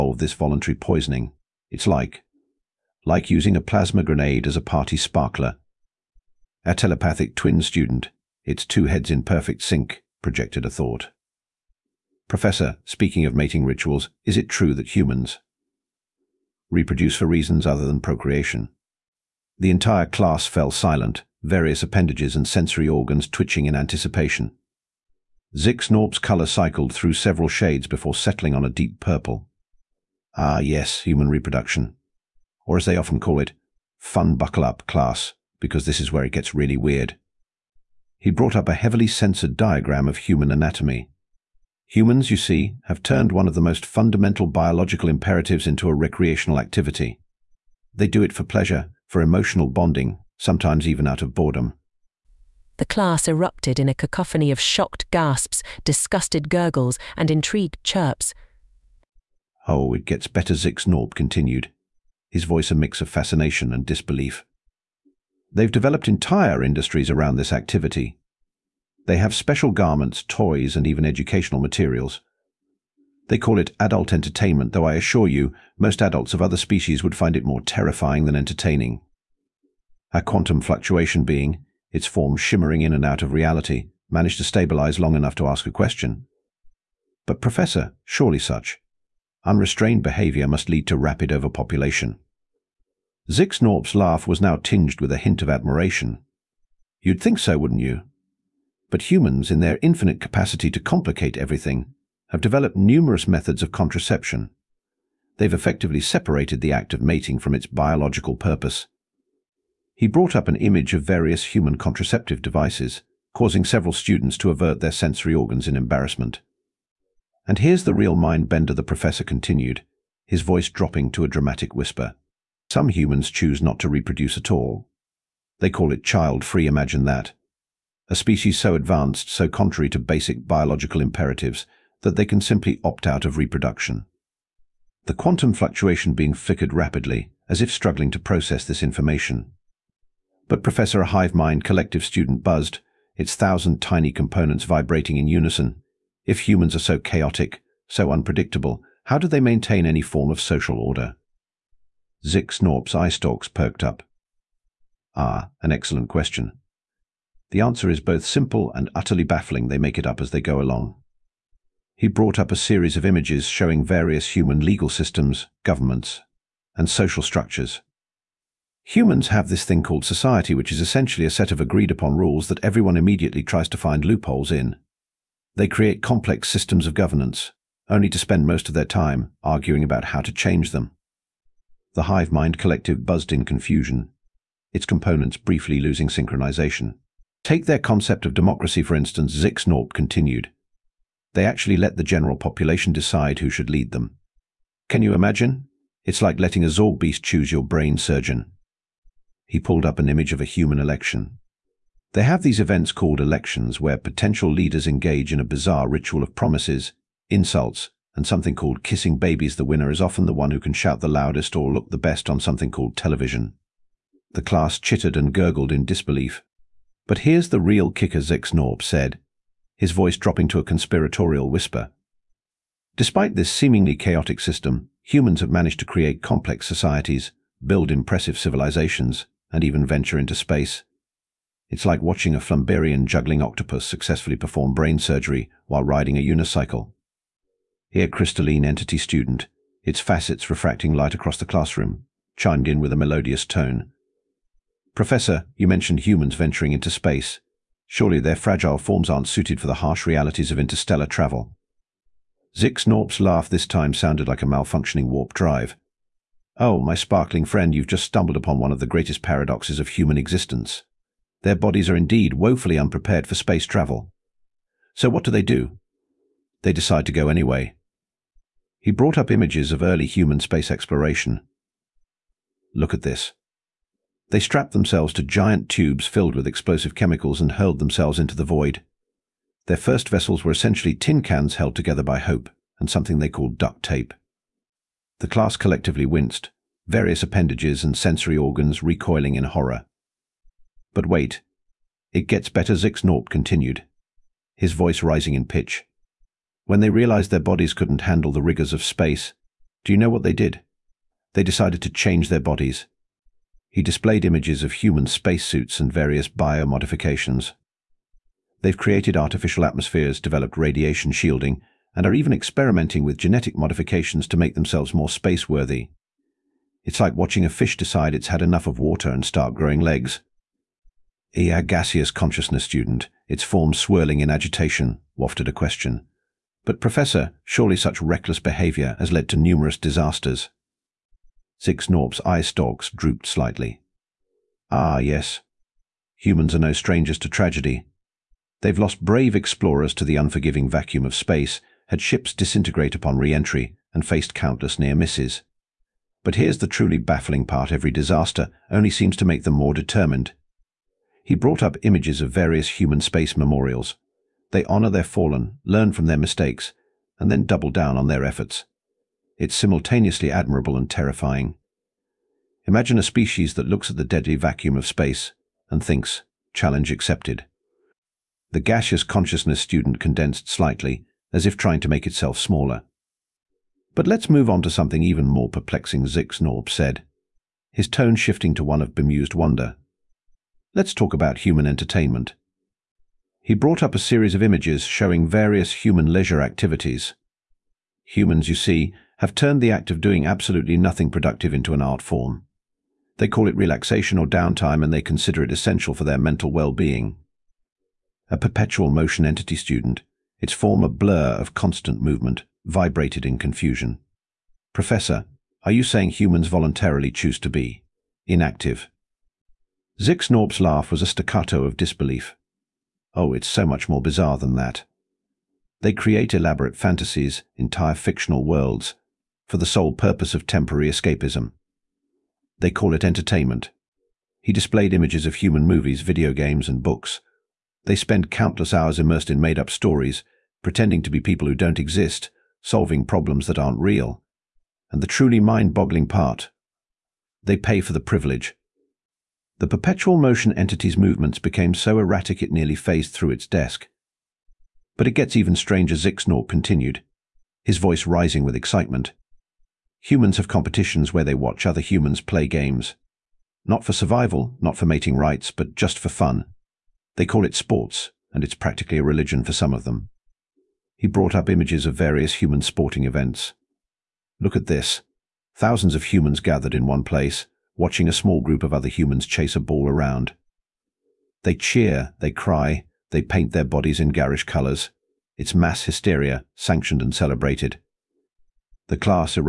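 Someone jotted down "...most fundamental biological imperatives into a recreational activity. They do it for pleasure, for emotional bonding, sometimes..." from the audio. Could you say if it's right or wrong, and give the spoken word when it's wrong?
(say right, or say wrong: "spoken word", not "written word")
right.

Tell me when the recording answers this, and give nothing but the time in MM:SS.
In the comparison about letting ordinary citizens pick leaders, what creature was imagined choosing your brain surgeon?
03:16.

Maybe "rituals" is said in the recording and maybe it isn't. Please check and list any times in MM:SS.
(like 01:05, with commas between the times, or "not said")
00:13, 03:25.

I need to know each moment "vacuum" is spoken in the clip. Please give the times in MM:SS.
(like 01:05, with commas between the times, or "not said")
05:40, 06:04.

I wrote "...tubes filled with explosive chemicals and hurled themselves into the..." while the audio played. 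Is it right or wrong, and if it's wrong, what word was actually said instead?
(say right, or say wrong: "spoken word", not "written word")
right.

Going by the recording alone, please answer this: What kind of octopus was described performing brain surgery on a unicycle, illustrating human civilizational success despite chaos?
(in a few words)
Flamberian juggling octopus.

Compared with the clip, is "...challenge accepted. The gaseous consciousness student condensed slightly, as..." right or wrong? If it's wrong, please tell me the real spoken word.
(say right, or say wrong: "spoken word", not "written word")
right.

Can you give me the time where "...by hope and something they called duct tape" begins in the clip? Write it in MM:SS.
04:42.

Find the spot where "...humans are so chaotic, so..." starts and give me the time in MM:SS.
02:26.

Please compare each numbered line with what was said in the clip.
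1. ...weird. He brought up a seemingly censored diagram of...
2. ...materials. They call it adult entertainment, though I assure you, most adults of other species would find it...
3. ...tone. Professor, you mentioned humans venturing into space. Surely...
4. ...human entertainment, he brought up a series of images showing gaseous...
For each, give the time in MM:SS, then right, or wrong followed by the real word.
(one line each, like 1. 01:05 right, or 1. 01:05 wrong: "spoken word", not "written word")
1. 00:36 wrong: "heavily", not "seemingly"
2. 01:11 right
3. 04:03 right
4. 06:21 wrong: "various", not "gaseous".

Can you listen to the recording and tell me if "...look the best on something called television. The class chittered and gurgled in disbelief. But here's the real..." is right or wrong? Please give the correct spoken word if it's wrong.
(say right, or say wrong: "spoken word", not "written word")
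right.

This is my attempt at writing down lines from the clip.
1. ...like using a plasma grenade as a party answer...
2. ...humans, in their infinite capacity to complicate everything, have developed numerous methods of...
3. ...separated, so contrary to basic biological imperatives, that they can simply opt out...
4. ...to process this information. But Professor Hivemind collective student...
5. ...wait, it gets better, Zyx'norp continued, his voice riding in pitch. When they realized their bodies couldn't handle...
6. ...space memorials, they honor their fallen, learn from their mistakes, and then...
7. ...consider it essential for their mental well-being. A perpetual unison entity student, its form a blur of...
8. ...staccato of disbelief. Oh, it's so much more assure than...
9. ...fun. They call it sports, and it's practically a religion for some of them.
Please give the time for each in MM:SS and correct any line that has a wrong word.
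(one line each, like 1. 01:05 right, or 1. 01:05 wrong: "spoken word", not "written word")
1. 00:03 wrong: "sparkler", not "answer"
2. 01:39 right
3. 02:08 wrong: "advanced", not "separated"
4. 02:18 right
5. 04:51 wrong: "rising", not "riding"
6. 05:53 right
7. 06:35 wrong: "motion", not "unison"
8. 06:51 wrong: "bizarre", not "assure"
9. 07:36 right.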